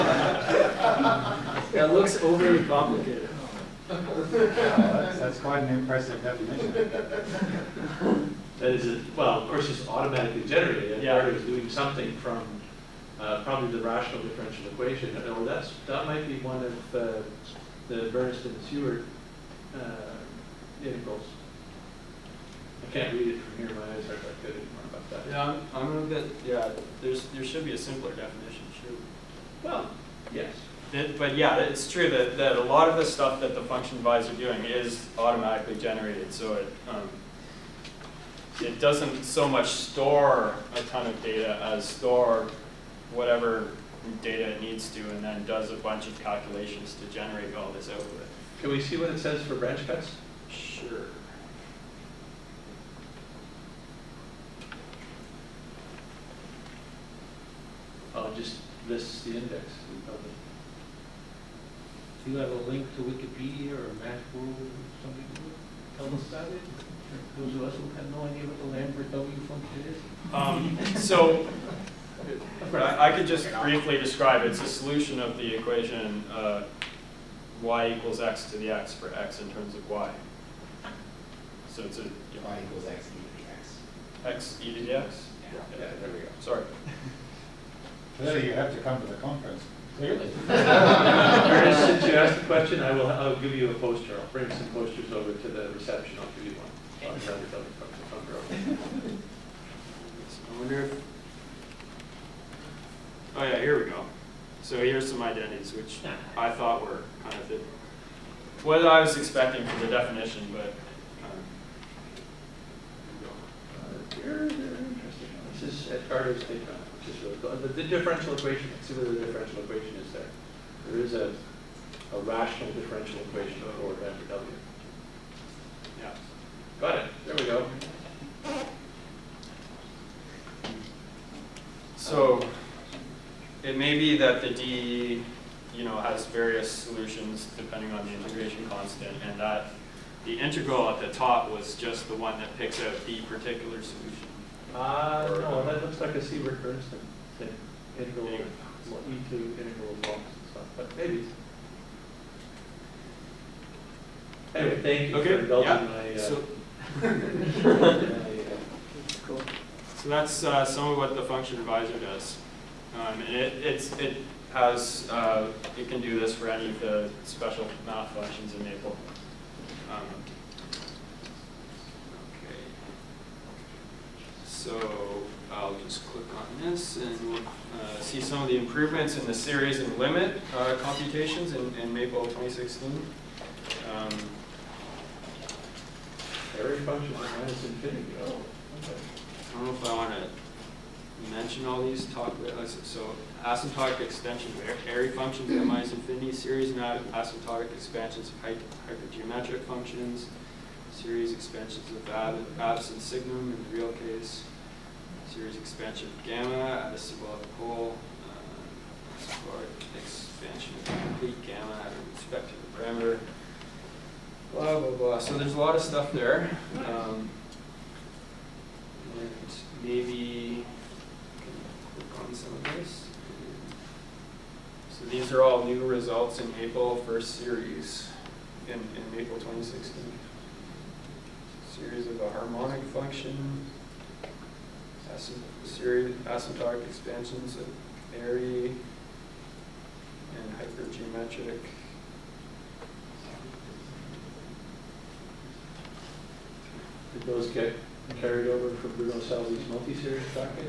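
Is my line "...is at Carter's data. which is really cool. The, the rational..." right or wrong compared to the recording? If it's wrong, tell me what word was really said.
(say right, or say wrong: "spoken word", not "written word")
wrong: "differential", not "rational".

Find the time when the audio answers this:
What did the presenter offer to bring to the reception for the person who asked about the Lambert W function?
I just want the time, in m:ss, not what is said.
1:34.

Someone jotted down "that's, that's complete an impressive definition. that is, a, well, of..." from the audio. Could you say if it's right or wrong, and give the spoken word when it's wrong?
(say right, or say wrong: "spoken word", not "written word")
wrong: "quite", not "complete".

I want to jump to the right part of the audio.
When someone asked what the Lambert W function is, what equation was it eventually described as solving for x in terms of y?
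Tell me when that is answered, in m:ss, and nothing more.
1:22.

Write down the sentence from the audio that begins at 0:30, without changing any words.
It, but yeah, it's true that, that a lot of the stuff that the function advisor are doing is automatically generated.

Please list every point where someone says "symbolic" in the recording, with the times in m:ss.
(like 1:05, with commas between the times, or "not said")
3:26.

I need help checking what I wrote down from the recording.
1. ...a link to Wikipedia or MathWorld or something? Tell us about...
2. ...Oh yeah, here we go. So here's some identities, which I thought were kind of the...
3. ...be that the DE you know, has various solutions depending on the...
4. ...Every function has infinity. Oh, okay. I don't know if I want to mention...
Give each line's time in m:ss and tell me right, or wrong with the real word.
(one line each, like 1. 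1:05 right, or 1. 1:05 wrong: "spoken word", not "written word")
1. 1:02 right
2. 1:43 right
3. 2:13 right
4. 3:06 right.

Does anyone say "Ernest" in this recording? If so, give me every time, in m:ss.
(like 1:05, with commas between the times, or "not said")
1:30.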